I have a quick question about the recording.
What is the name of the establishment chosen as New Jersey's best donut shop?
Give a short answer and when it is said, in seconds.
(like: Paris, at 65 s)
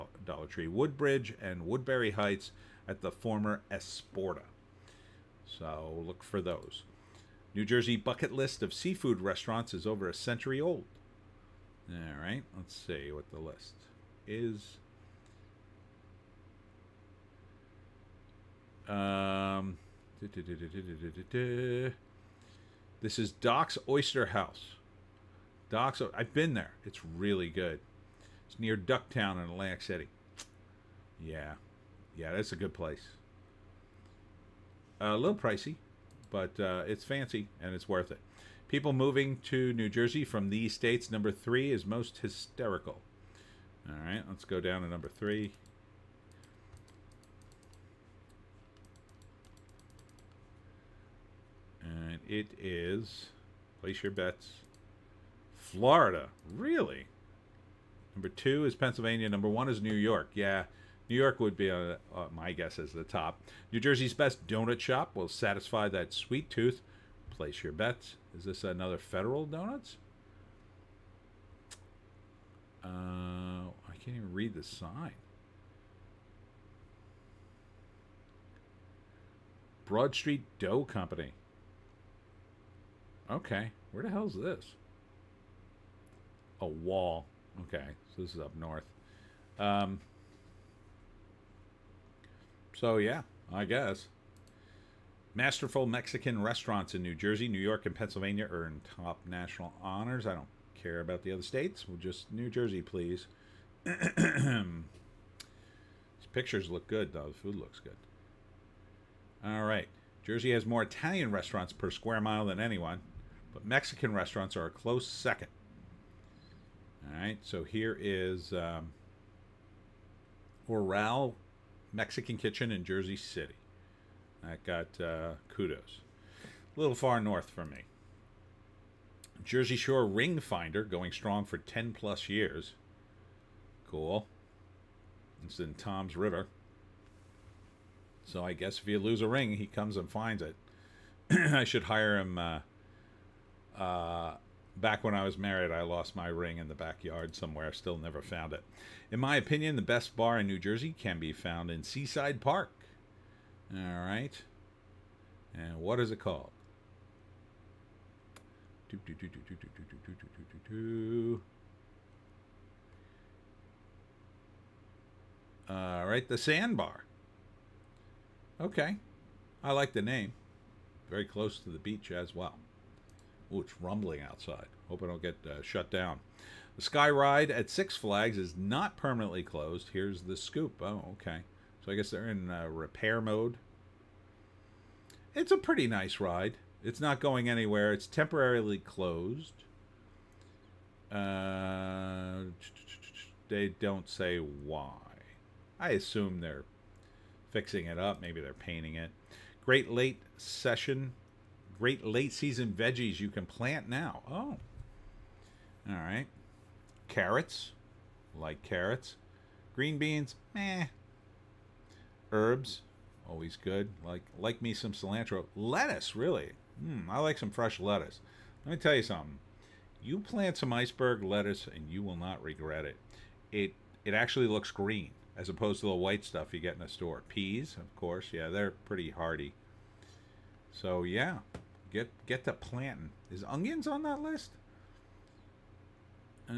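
Broad Street Dough Company, at 79 s.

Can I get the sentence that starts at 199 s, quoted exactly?
Great Late Session great late season veggies you can plant now.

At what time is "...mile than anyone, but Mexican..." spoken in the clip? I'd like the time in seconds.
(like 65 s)
112 s.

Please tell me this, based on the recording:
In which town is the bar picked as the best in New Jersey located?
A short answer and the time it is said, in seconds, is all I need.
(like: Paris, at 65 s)
Seaside Park, at 151 s.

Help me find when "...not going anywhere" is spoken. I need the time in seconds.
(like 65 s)
186 s.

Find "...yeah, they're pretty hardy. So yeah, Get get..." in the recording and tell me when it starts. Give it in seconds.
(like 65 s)
228 s.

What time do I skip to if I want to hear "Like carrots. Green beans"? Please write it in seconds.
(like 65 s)
208 s.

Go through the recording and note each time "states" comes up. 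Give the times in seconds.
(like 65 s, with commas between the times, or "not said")
40 s, 101 s.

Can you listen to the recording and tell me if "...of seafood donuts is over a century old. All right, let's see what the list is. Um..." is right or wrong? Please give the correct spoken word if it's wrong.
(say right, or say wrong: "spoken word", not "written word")
wrong: "restaurants", not "donuts".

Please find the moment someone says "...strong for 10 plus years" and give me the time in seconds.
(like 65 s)
131 s.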